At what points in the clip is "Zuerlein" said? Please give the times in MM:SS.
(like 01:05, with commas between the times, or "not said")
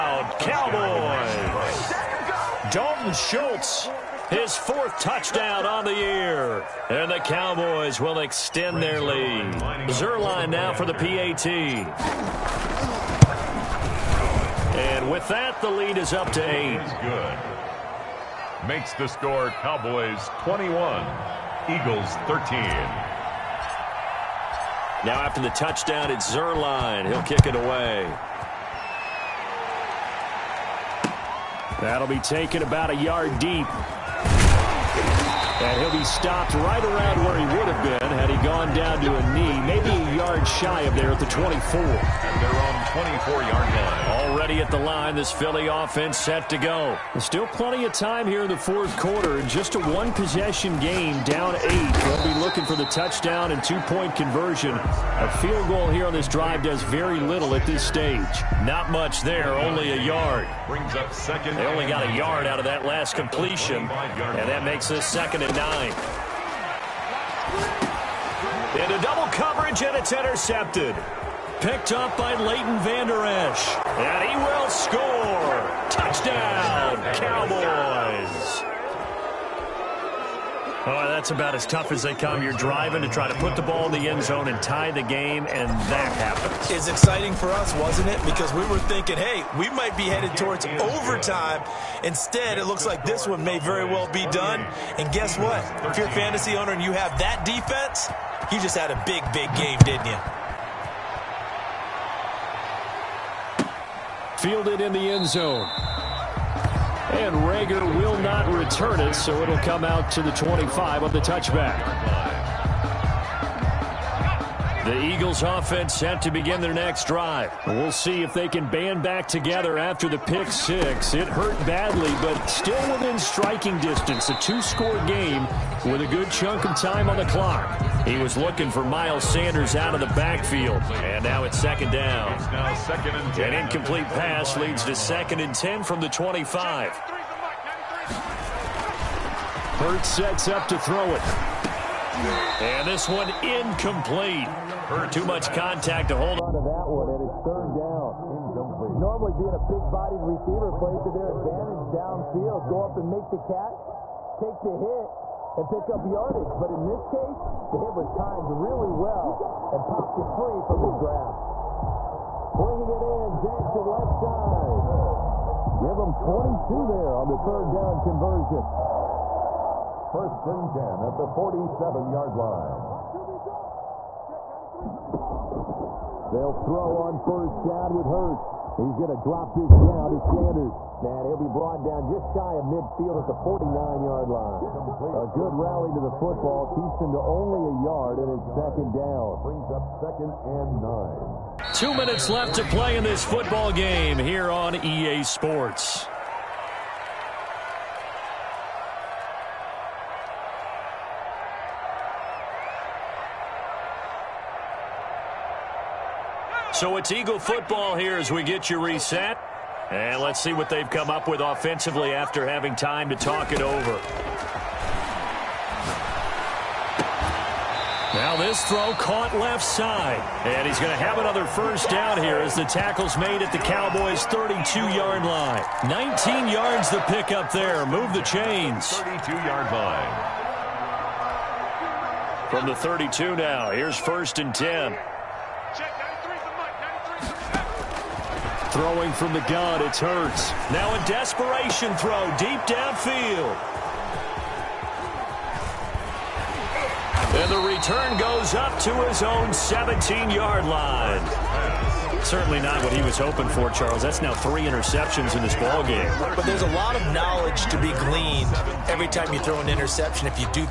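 00:09, 00:26.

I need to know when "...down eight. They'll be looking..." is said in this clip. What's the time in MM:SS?
00:51.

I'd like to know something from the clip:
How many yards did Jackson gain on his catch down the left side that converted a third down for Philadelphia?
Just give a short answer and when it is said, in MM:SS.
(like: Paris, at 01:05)
22, at 02:46.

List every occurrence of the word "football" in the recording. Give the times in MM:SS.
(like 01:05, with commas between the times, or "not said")
03:06, 03:13, 03:27.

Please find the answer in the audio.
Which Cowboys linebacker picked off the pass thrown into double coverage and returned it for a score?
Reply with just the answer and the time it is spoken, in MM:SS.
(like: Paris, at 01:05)
Leighton Vander Esch, at 01:12.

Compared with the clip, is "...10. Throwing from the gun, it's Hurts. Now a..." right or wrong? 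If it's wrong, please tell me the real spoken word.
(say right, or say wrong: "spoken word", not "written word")
right.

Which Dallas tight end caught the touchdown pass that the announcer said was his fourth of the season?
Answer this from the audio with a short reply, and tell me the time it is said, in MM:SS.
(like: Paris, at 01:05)
Dalton Schultz, at 00:02.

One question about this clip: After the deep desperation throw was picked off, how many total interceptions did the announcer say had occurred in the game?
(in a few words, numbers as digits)
3.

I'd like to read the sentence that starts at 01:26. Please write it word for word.
It's exciting for us, wasn't it?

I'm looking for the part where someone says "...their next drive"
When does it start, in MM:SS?
01:56.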